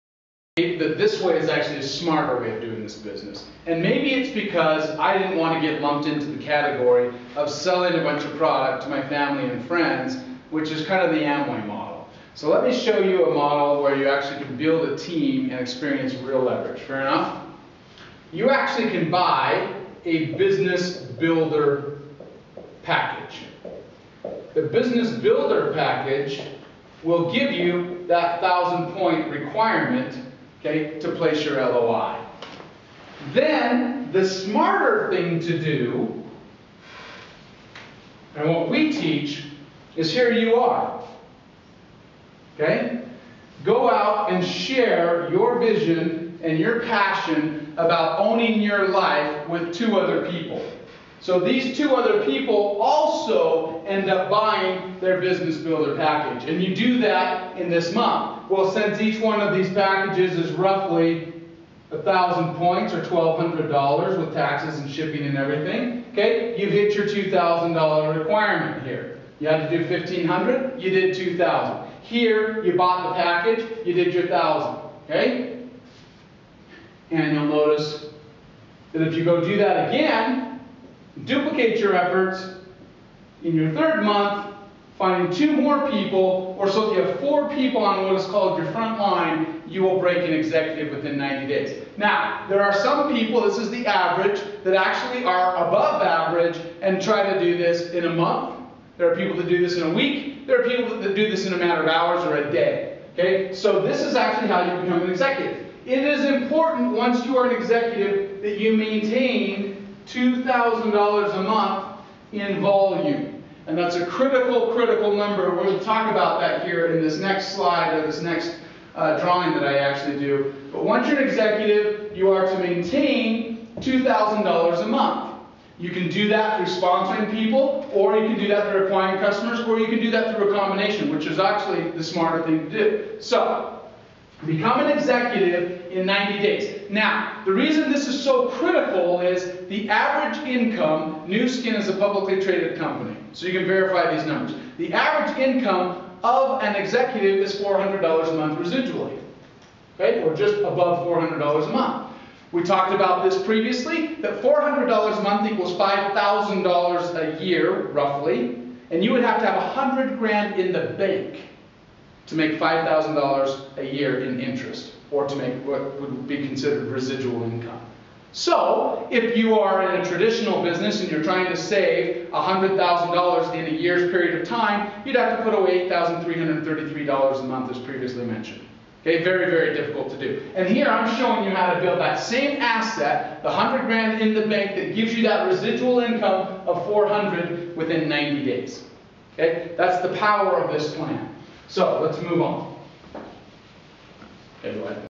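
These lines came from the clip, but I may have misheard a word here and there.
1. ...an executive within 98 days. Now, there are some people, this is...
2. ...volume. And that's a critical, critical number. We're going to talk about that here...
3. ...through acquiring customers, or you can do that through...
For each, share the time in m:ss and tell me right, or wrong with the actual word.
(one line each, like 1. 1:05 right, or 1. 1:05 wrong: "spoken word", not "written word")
1. 1:30 wrong: "90", not "98"
2. 1:52 right
3. 2:08 right.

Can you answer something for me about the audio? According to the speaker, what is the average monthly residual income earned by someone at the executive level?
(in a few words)
$400.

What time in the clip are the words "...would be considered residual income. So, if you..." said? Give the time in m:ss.
2:45.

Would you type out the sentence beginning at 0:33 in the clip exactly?
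Then the smarter thing to do, and what we teach, is here you are.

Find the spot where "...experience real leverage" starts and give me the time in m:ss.
0:15.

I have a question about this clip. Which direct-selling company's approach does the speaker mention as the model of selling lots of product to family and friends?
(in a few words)
Amway.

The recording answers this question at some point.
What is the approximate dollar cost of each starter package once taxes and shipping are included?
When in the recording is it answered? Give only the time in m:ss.
1:03.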